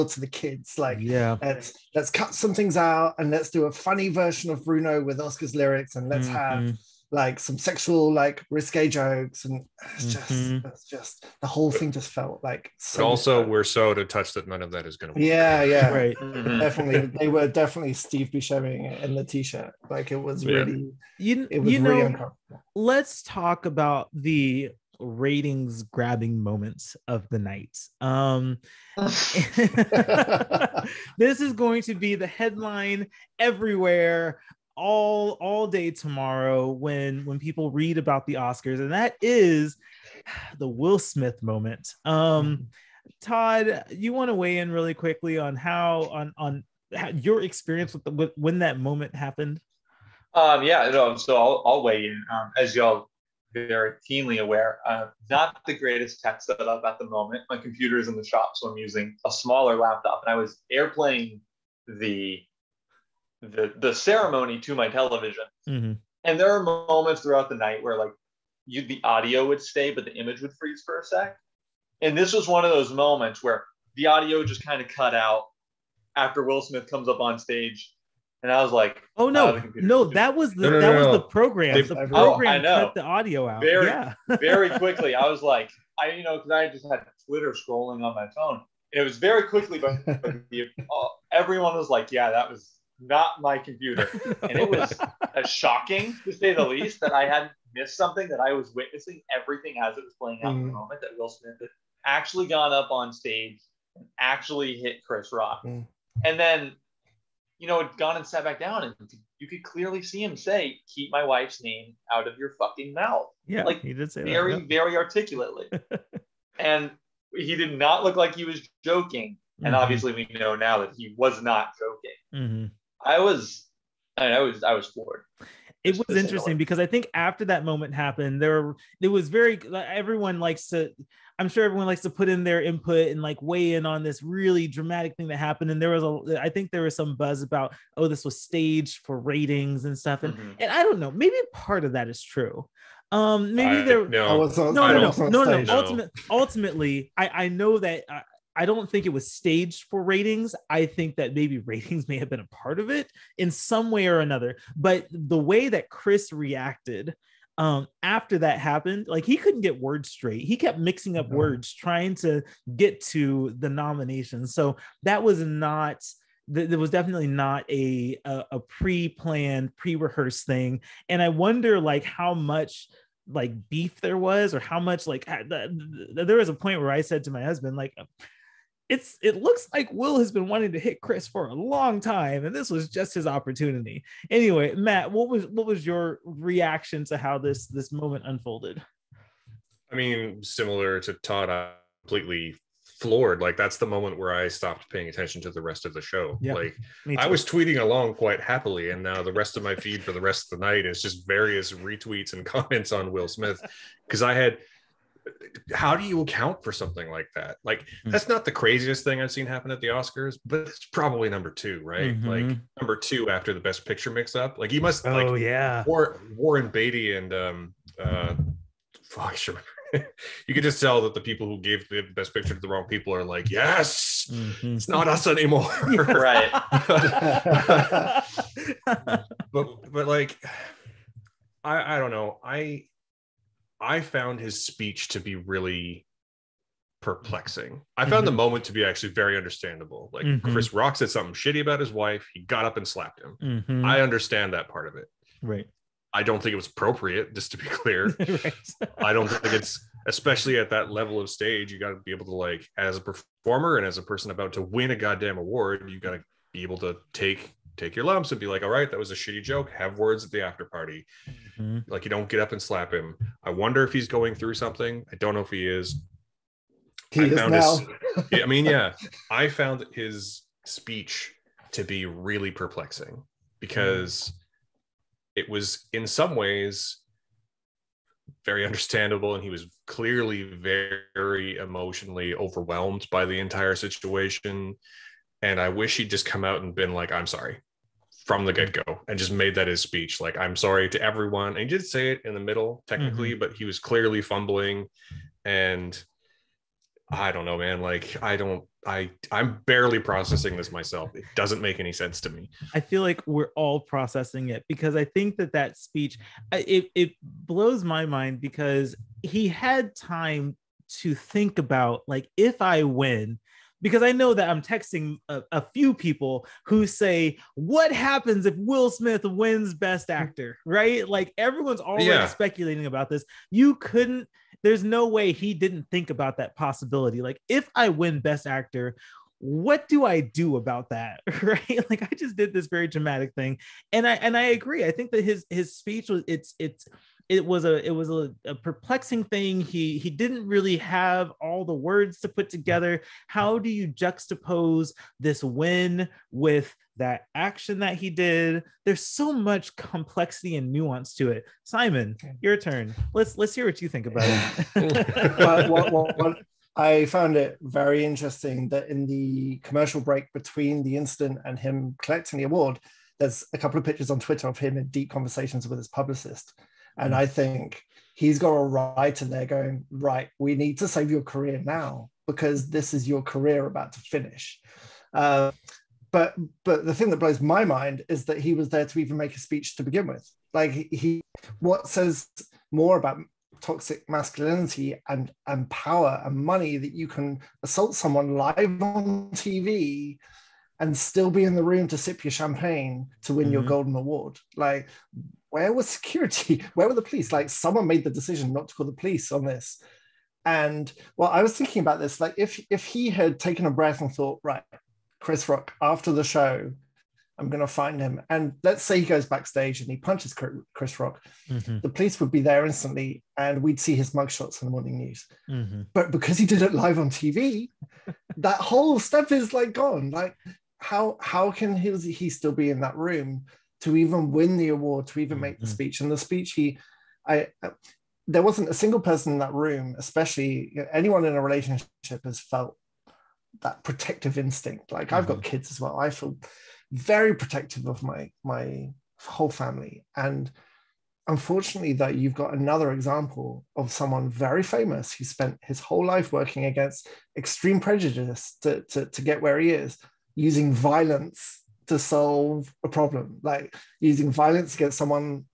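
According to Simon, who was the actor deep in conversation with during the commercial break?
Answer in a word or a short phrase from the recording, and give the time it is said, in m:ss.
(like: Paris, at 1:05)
His publicist, at 6:05.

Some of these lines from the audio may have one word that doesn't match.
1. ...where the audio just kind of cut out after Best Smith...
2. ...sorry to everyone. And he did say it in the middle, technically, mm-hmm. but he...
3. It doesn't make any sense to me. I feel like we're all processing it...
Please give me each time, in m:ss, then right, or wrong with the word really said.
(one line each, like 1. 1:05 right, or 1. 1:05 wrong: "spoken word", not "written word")
1. 1:13 wrong: "Will", not "Best"
2. 4:50 right
3. 5:01 right.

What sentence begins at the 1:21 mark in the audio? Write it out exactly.
the oh, program oh, cut the audio out very, yeah.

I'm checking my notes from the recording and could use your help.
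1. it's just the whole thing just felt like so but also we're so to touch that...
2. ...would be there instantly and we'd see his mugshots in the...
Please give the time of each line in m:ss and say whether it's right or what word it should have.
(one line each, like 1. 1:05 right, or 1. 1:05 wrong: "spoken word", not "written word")
1. 0:10 right
2. 6:52 right.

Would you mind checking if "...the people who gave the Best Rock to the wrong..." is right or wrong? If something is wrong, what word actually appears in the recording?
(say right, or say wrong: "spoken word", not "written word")
wrong: "Picture", not "Rock".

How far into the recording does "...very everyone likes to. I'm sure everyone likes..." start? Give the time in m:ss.
2:09.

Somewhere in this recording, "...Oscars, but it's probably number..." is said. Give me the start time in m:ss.
3:29.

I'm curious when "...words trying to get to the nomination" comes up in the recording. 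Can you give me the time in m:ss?
2:41.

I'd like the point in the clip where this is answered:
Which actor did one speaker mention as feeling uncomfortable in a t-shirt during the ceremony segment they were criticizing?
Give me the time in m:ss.
0:17.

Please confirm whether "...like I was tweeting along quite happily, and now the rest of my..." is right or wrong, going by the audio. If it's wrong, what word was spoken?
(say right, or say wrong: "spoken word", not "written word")
right.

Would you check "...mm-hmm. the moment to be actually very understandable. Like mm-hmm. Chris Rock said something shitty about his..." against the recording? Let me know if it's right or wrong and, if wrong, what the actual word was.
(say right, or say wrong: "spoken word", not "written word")
right.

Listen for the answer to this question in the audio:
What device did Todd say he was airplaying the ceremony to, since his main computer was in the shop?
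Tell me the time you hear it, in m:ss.
1:04.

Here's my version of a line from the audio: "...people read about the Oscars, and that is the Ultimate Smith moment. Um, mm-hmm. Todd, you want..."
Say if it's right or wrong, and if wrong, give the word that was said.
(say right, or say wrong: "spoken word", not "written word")
wrong: "Will", not "Ultimate".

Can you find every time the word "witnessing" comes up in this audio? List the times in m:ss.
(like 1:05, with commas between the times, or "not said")
1:38.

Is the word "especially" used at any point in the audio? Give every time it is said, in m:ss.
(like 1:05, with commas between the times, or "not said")
4:10, 7:09.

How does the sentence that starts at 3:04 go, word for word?
Anyway, Matt, what was what was your reaction to how this this moment unfolded?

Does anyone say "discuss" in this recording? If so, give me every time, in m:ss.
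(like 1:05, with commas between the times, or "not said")
not said.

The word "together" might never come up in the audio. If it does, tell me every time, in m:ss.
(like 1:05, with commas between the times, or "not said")
5:42.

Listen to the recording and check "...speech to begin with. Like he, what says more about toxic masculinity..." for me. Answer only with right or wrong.
right.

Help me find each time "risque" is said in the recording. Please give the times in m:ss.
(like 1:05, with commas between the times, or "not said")
0:08.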